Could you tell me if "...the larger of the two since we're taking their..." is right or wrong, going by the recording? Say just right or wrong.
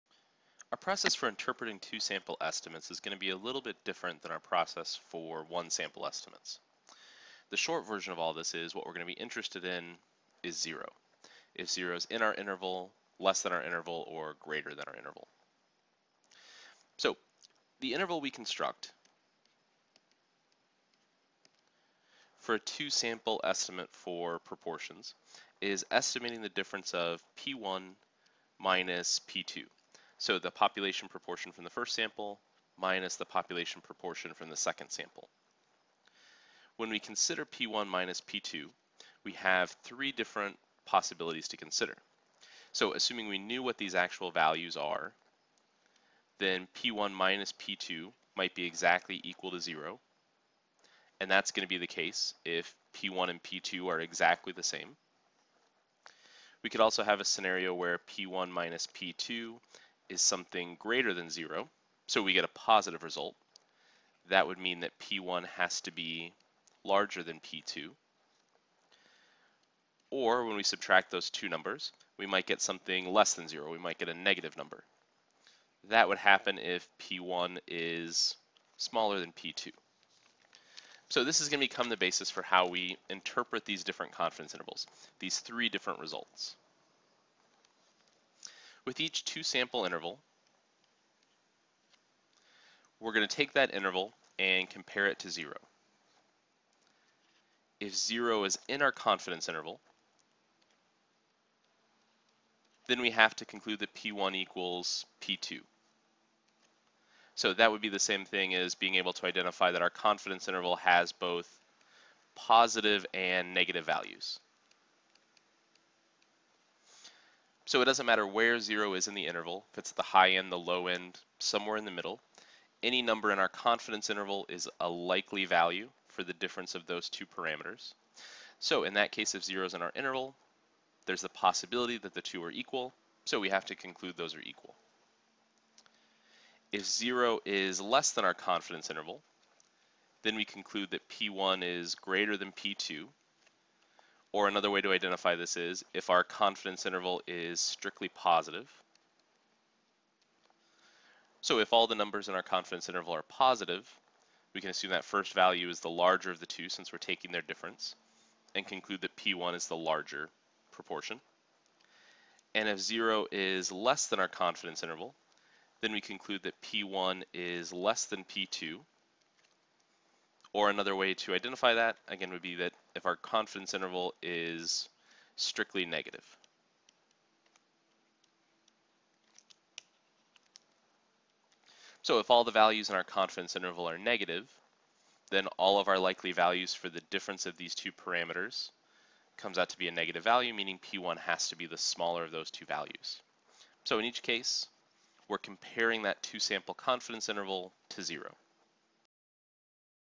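right.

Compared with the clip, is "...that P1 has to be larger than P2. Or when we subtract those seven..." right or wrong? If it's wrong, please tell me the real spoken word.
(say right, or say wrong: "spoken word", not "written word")
wrong: "two", not "seven".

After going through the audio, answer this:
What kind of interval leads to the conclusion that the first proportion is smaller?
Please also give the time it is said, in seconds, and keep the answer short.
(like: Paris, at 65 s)
strictly negative, at 175 s.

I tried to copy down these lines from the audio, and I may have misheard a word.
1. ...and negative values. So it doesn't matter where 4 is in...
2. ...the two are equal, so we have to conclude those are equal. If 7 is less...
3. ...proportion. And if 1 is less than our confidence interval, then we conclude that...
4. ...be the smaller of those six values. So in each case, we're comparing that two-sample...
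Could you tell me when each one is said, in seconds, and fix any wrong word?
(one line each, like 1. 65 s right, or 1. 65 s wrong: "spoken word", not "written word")
1. 113 s wrong: "0", not "4"
2. 132 s wrong: "0", not "7"
3. 160 s wrong: "0", not "1"
4. 191 s wrong: "two", not "six".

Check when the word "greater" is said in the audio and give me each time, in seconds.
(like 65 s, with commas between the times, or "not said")
14 s, 60 s, 141 s.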